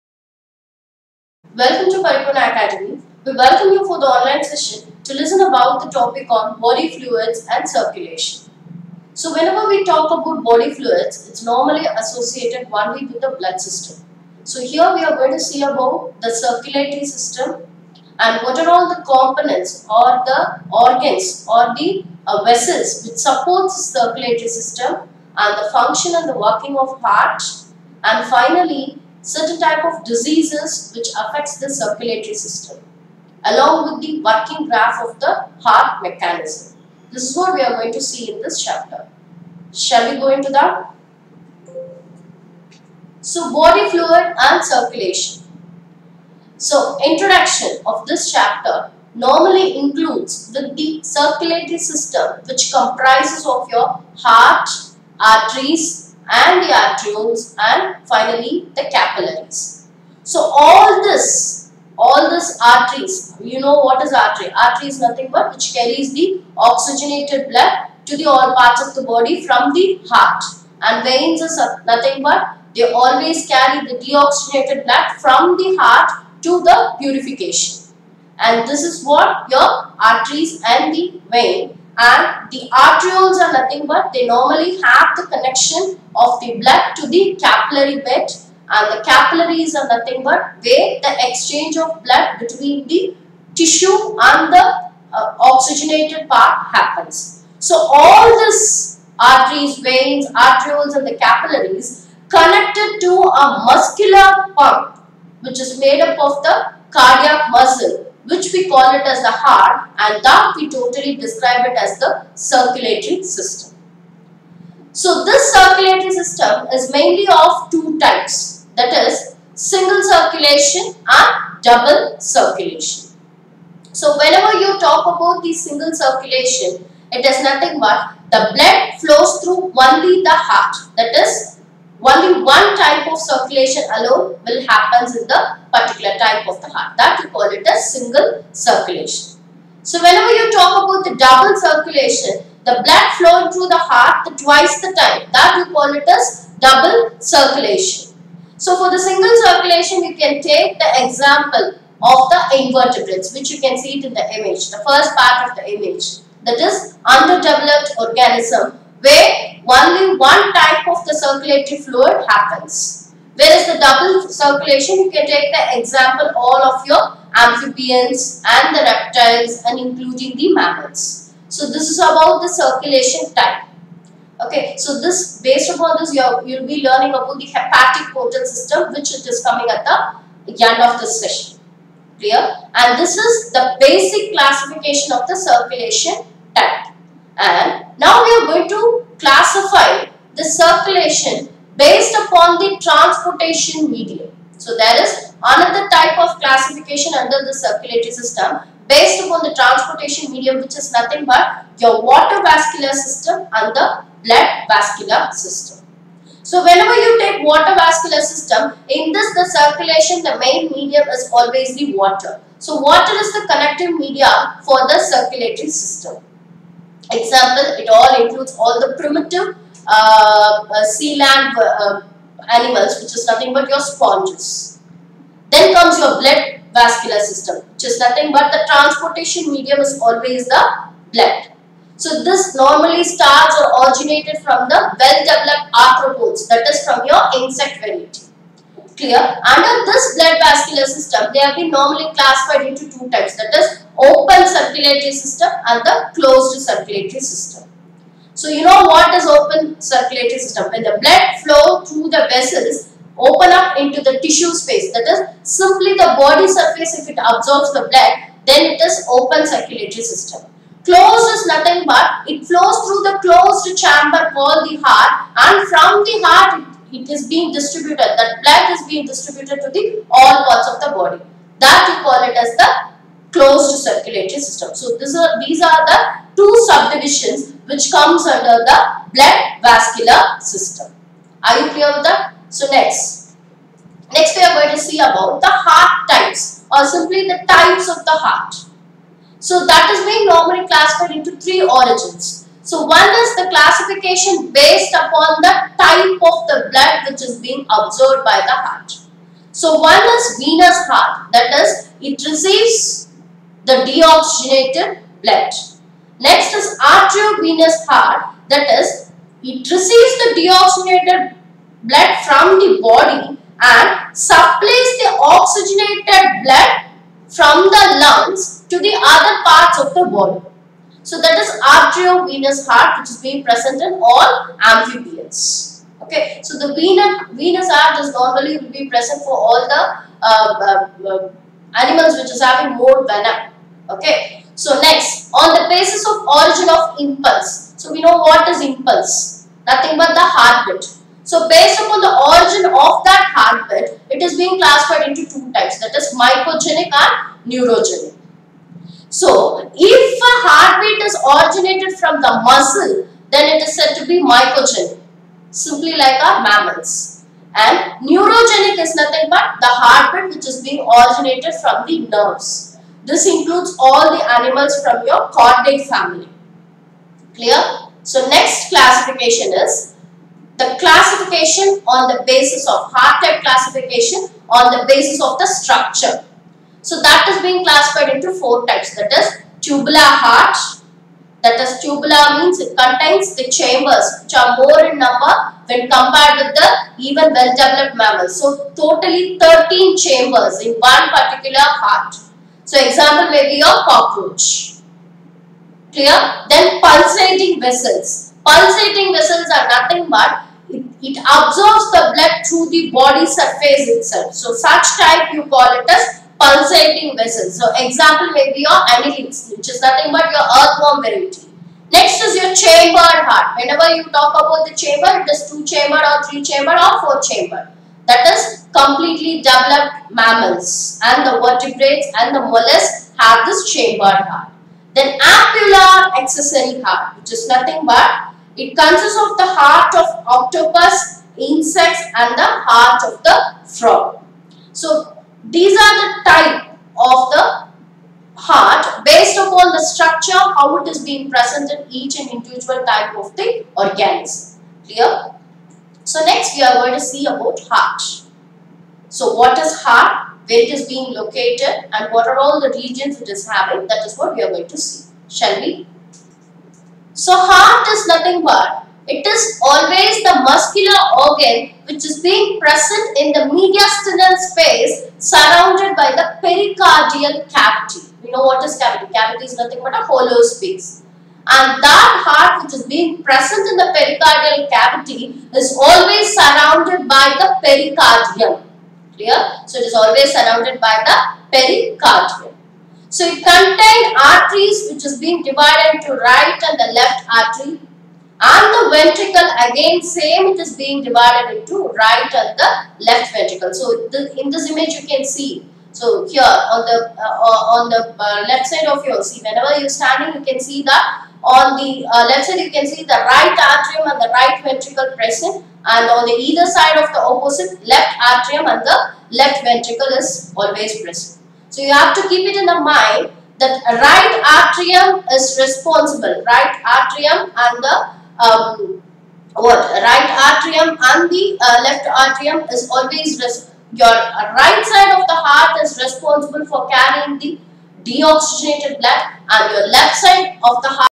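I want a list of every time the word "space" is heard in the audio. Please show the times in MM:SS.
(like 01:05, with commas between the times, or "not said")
04:14, 07:44, 07:50.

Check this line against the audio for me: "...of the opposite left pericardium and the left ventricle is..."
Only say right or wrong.
wrong.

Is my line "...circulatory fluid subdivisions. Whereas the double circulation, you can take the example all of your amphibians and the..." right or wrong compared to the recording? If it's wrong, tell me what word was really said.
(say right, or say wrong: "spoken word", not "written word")
wrong: "happens", not "subdivisions".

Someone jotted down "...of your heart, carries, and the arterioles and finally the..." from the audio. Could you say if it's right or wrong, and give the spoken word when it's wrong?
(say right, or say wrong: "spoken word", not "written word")
wrong: "arteries", not "carries".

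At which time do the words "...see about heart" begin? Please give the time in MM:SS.
07:26.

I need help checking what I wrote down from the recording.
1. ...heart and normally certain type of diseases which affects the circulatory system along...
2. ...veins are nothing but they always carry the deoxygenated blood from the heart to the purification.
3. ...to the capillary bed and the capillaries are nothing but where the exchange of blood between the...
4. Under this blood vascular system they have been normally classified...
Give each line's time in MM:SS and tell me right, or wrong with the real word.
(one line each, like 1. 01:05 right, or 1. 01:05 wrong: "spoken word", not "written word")
1. 00:27 wrong: "finally", not "normally"
2. 01:11 right
3. 01:26 right
4. 03:59 right.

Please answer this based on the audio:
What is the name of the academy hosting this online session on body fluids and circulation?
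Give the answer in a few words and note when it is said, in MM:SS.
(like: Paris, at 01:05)
Paripoorna Academy, at 00:02.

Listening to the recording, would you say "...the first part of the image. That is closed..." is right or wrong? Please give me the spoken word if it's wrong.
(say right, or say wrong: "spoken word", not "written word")
wrong: "underdeveloped", not "closed".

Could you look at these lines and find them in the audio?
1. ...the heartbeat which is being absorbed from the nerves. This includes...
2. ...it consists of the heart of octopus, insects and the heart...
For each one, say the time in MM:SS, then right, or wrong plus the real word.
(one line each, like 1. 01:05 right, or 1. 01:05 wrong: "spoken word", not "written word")
1. 05:59 wrong: "originated", not "absorbed"
2. 07:08 right.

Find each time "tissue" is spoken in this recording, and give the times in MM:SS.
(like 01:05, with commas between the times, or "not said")
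01:33, 04:14.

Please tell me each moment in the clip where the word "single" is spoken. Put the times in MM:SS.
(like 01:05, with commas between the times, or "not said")
01:59, 02:05, 02:17, 02:28.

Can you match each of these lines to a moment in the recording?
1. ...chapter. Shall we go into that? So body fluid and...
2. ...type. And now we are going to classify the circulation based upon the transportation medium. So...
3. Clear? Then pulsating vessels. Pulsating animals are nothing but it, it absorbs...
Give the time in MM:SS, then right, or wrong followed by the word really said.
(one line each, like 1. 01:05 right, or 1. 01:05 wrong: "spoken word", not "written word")
1. 00:38 right
2. 03:06 right
3. 06:35 wrong: "vessels", not "animals".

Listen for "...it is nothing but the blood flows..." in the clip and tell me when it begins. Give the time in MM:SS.
02:07.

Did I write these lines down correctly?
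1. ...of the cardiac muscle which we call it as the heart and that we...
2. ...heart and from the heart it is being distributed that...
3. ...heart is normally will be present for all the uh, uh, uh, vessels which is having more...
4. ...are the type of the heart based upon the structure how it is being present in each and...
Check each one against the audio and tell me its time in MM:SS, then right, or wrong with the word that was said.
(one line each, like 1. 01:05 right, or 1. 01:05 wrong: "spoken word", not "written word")
1. 01:46 right
2. 04:24 right
3. 05:27 wrong: "animals", not "vessels"
4. 07:15 right.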